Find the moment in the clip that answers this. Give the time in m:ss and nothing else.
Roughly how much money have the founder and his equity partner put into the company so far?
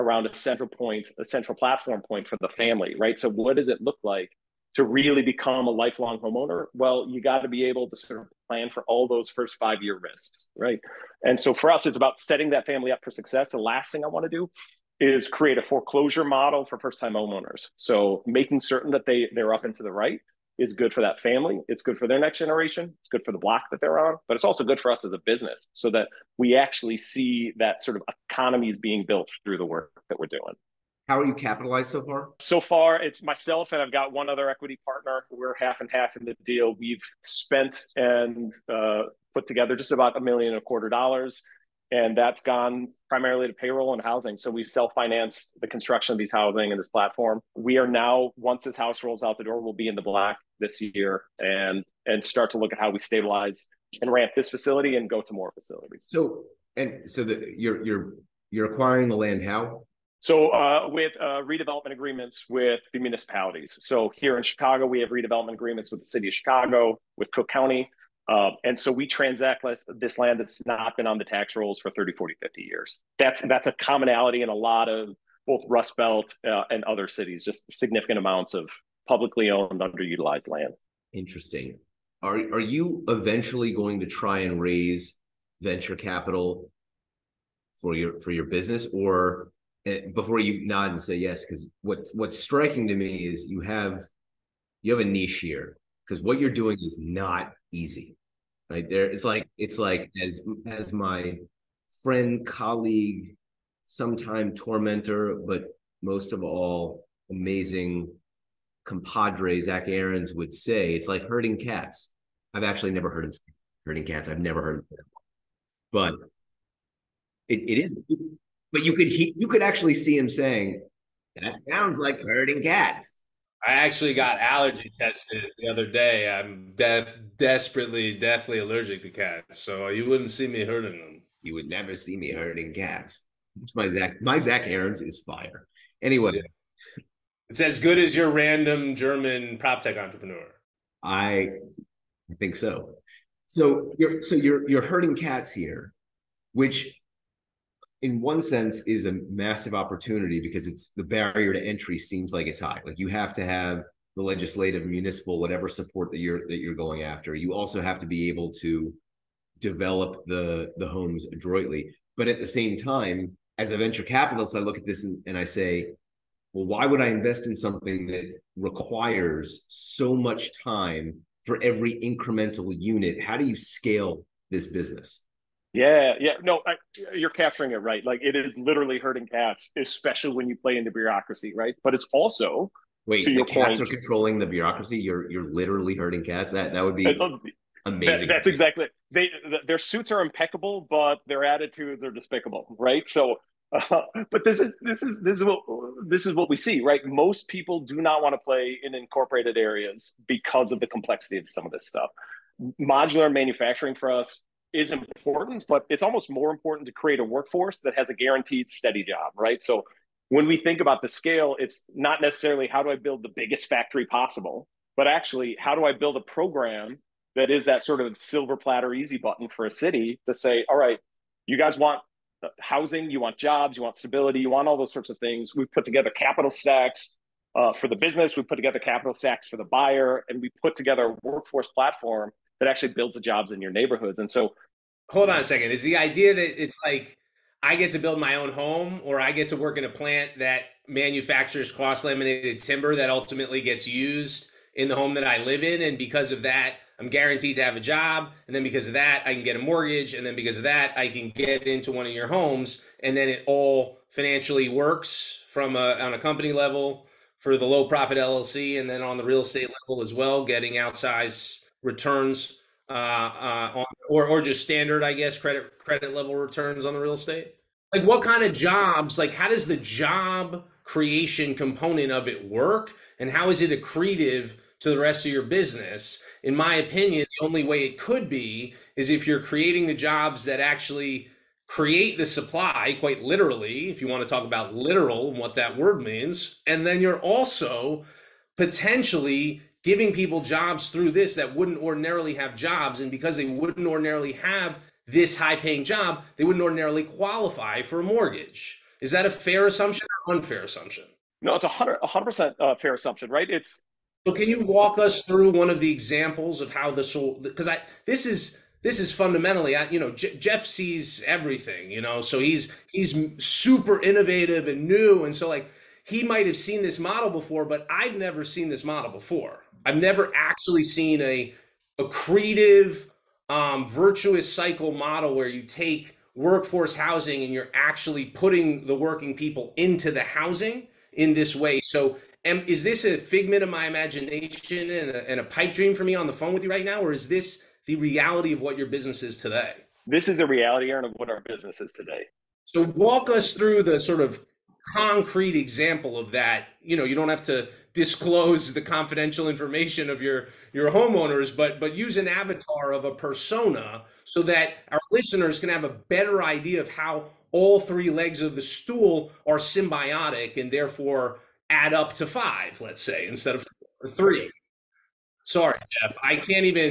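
0:40.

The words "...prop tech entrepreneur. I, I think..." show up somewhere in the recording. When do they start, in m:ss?
2:19.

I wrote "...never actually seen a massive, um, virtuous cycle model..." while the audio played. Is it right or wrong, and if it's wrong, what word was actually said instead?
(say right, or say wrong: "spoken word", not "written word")
wrong: "accretive", not "massive".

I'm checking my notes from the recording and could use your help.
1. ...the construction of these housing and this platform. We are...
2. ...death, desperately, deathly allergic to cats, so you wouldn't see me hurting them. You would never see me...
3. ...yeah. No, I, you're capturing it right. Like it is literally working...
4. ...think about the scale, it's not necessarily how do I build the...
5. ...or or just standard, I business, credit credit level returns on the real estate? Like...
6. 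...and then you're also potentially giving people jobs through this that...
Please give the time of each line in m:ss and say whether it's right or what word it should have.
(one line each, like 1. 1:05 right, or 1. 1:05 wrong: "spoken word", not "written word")
1. 0:45 right
2. 2:06 right
3. 2:56 wrong: "hurting", not "working"
4. 3:30 right
5. 4:24 wrong: "guess", not "business"
6. 4:46 right.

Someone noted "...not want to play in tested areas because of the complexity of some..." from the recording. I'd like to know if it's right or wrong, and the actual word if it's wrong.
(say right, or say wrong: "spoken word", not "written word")
wrong: "incorporated", not "tested".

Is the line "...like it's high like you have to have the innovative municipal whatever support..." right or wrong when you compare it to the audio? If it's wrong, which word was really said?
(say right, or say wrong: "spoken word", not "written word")
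wrong: "legislative", not "innovative".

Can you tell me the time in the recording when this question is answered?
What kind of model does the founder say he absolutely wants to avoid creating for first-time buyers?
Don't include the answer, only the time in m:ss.
0:15.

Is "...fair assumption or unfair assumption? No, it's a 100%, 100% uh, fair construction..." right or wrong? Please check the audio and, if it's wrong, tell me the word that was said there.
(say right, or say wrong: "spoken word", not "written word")
wrong: "assumption", not "construction".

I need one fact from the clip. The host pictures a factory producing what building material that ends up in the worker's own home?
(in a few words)
Cross laminated timber.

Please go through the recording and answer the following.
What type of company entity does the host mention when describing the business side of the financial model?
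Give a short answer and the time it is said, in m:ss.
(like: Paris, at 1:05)
Low profit LLC, at 4:17.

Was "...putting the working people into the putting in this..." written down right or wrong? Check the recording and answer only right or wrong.
wrong.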